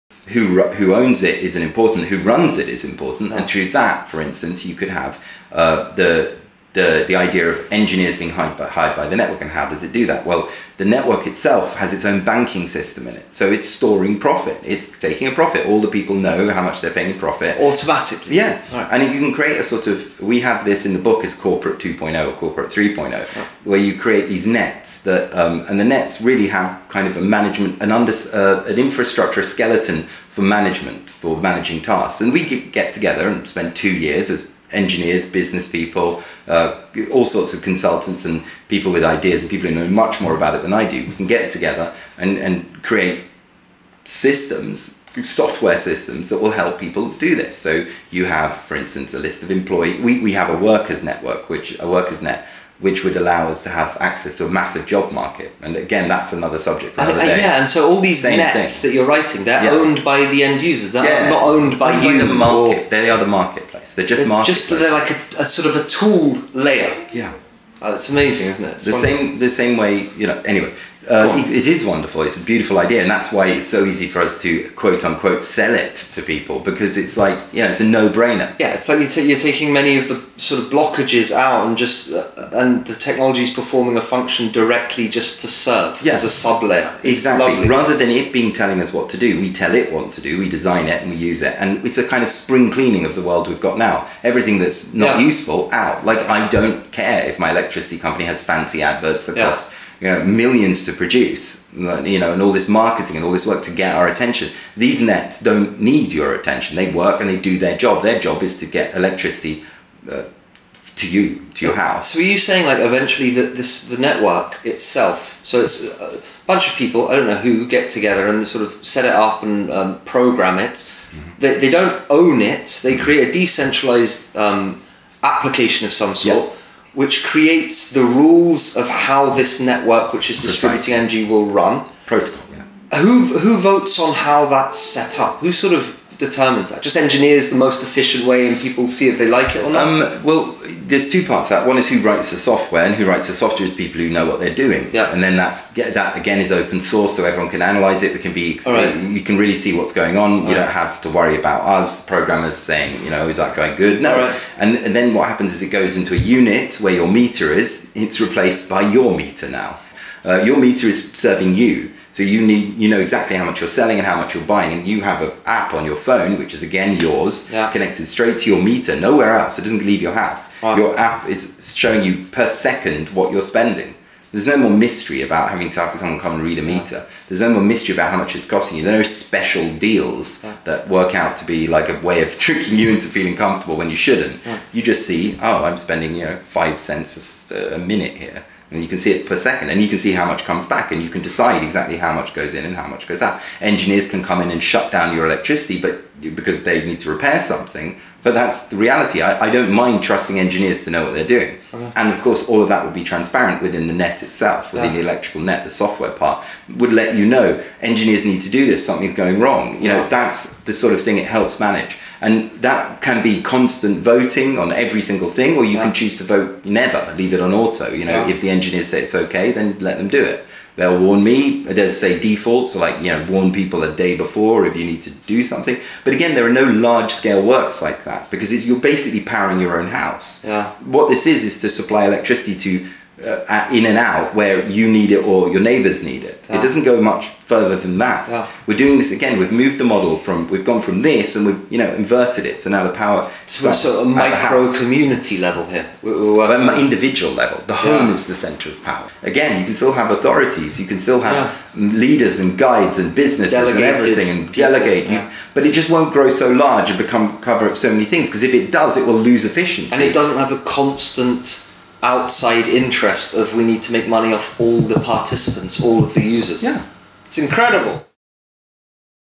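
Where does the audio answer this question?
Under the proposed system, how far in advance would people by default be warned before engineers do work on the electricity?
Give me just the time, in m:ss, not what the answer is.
3:43.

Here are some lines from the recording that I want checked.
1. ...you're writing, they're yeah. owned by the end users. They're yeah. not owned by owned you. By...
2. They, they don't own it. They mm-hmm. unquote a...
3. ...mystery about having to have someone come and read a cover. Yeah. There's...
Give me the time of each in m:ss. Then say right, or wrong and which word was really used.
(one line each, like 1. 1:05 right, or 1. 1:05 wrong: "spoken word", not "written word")
1. 0:58 right
2. 2:01 wrong: "create", not "unquote"
3. 2:54 wrong: "meter", not "cover".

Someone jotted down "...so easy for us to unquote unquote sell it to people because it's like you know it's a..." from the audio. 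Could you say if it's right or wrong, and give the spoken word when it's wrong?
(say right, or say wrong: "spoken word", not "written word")
wrong: "quote", not "unquote".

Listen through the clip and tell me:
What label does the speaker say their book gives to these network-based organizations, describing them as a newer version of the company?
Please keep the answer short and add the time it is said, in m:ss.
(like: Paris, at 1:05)
corporate 2.0, at 0:21.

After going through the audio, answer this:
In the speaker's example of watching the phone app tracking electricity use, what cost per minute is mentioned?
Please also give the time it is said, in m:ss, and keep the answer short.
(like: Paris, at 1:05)
5 cents a minute, at 3:06.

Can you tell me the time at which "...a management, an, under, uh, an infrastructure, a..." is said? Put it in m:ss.
0:27.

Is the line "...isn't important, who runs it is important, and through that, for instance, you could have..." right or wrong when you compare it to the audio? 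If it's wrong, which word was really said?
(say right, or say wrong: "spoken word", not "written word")
right.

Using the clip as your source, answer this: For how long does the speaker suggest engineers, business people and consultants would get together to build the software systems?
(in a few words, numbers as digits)
two years.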